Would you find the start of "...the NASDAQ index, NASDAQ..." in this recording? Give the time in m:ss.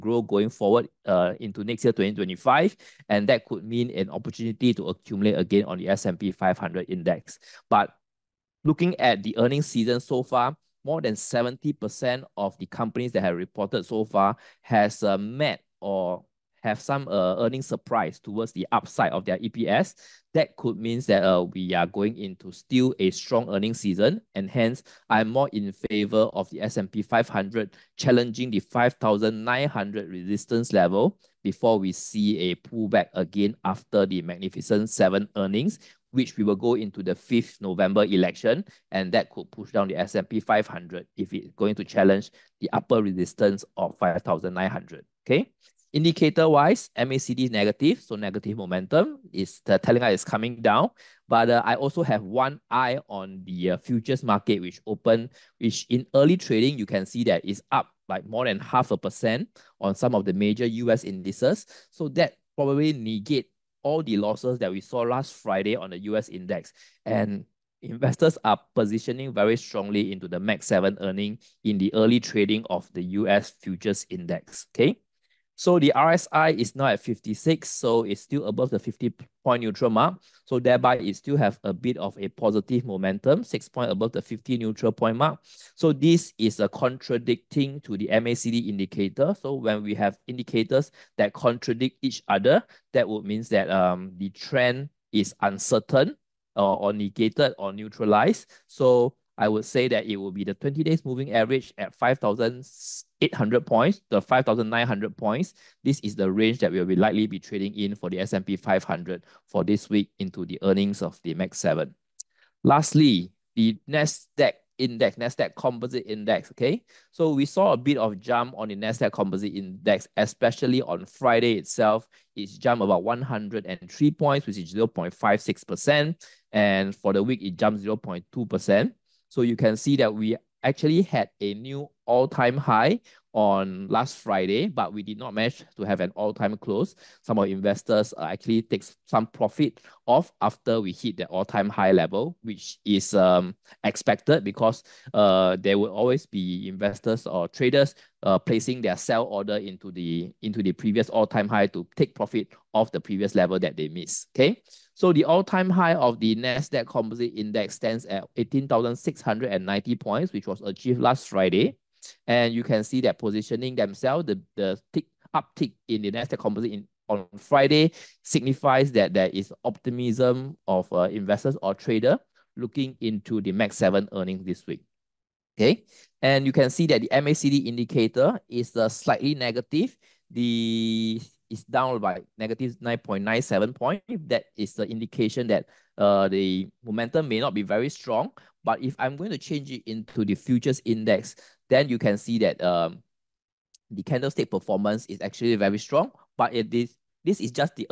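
1:53.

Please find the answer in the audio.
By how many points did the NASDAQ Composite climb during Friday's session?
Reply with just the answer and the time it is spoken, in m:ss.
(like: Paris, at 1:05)
103, at 2:03.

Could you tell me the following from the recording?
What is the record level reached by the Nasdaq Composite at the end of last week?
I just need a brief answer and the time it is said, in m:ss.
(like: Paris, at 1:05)
18,690, at 2:38.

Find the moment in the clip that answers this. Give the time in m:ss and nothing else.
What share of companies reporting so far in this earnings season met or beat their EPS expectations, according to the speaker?
0:10.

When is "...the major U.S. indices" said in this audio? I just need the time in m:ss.
1:00.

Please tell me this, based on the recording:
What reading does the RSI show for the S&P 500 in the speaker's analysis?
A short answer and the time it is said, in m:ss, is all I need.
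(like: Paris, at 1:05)
56, at 1:17.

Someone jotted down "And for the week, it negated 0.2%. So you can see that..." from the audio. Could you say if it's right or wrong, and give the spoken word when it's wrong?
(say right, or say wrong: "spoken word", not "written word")
wrong: "jumped", not "negated".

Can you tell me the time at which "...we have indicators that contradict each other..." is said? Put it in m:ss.
1:29.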